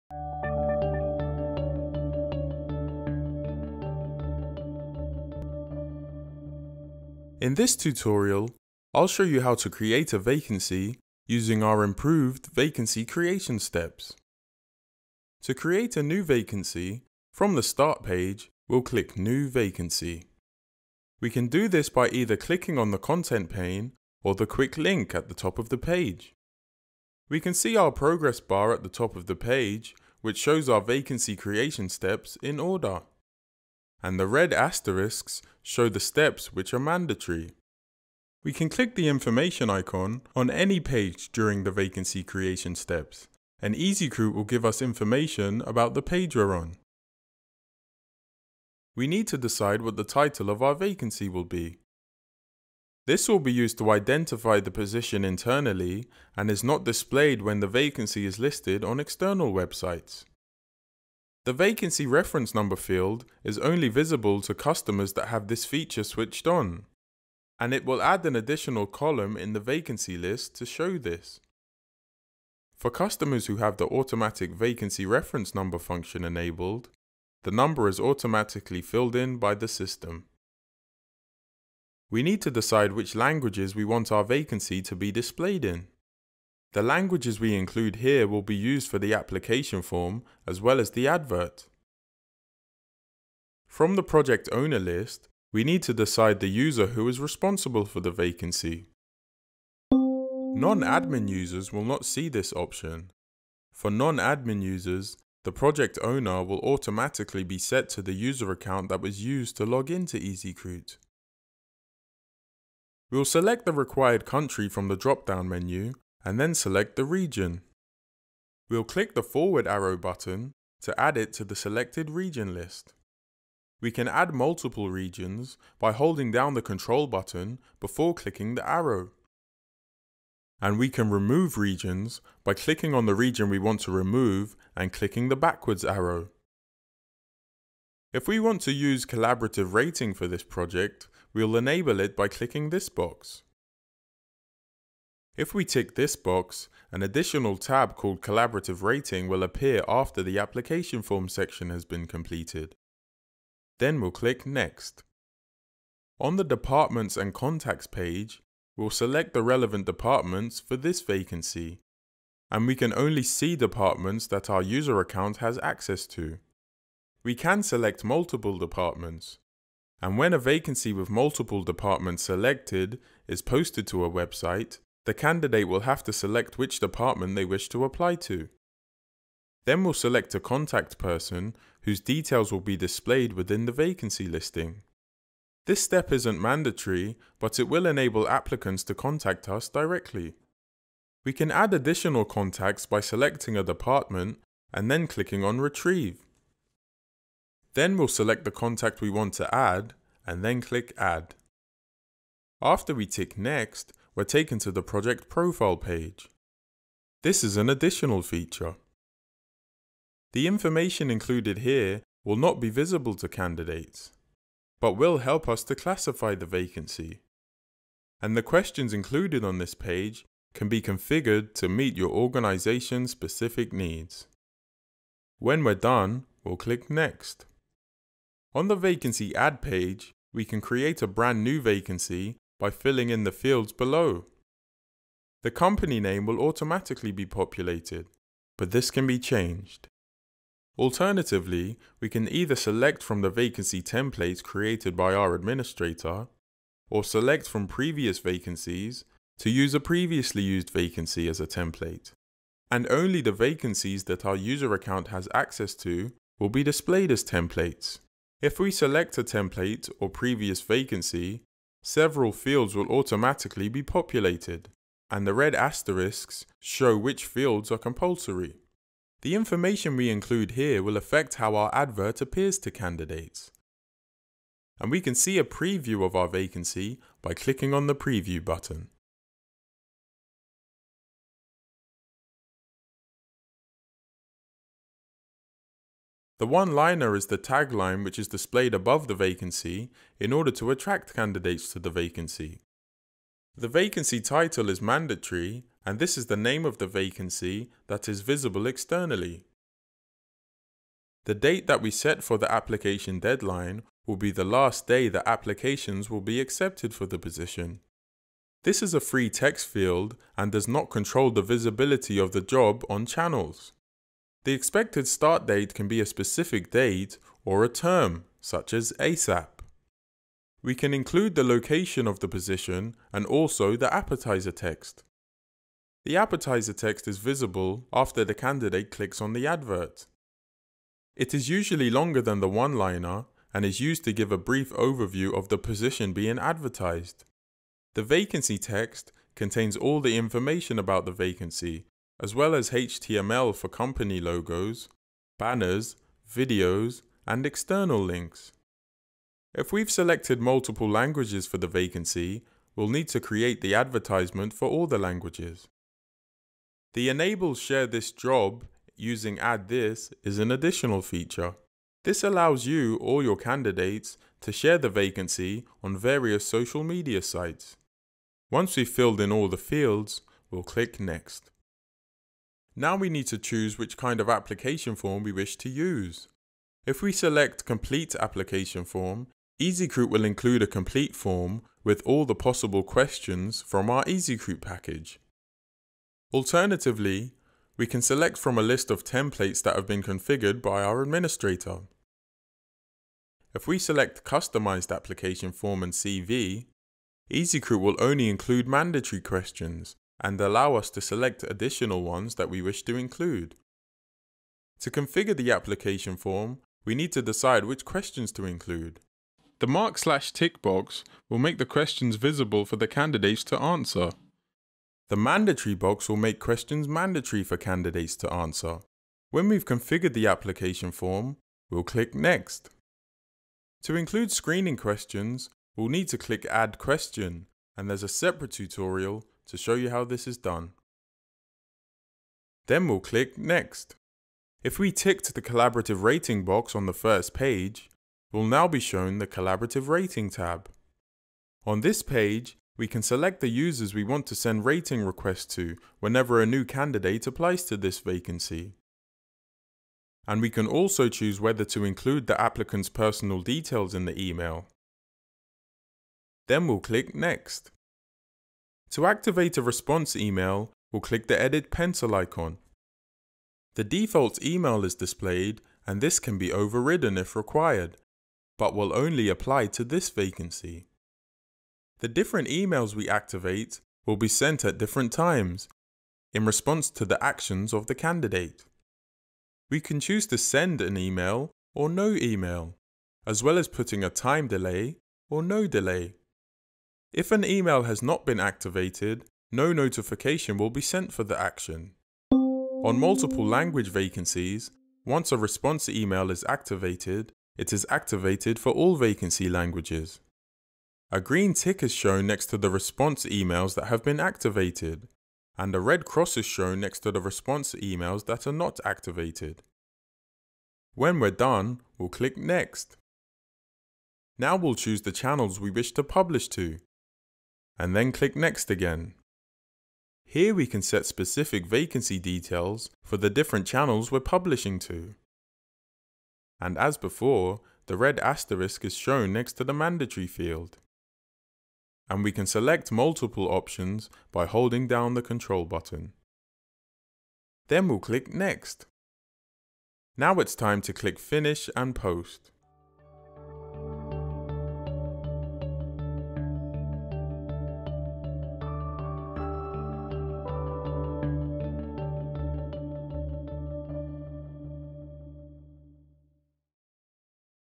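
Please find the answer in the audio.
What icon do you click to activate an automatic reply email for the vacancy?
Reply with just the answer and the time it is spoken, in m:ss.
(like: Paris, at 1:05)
edit pencil icon, at 7:41.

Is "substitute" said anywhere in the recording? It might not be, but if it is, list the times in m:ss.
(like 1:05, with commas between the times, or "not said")
not said.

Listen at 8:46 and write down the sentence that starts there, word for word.
And as before, the red asterisk is shown next to the mandatory field.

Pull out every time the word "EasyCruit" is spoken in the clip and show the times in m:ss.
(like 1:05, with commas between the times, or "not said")
0:43, 1:50, 6:19, 6:24, 6:37.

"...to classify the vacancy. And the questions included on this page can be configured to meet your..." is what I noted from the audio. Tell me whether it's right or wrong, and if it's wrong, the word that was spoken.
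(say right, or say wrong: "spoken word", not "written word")
right.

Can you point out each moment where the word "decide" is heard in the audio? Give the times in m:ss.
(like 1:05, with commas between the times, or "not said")
0:49, 1:22, 1:35, 6:47.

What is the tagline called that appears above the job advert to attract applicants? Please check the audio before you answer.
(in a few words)
one liner.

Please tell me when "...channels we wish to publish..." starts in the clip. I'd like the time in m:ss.
8:35.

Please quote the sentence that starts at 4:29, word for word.
The information we include here will affect how our advert appears to candidates.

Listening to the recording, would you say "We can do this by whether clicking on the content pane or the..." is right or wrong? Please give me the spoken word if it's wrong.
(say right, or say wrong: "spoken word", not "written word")
wrong: "either", not "whether".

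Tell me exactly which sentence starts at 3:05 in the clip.
This step isn't mandatory, but it will enable applicants to contact us directly.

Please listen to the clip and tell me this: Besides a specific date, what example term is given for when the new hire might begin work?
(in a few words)
ASAP.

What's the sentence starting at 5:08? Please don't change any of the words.
This is a free text field and does not control the visibility of the job on channels.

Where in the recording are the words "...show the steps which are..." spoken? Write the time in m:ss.
0:35.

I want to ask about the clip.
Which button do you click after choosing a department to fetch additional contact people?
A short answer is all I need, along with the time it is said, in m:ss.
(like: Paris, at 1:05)
Retrieve, at 3:15.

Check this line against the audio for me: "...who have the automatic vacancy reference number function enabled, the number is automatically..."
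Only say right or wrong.
right.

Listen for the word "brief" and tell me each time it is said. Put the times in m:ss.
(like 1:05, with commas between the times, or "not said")
5:34.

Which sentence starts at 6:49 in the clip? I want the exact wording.
The mark slash tick box will make the questions visible for the candidates to answer.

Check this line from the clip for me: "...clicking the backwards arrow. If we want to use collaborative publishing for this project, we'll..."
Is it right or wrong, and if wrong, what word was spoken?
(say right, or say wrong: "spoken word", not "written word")
wrong: "rating", not "publishing".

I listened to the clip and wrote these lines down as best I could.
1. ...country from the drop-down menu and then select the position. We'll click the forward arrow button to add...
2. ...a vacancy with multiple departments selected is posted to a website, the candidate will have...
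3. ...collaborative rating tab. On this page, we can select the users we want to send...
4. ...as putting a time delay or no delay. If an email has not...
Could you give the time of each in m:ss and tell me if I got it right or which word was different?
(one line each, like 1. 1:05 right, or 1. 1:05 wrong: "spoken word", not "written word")
1. 1:54 wrong: "region", not "position"
2. 2:50 right
3. 7:19 right
4. 8:03 right.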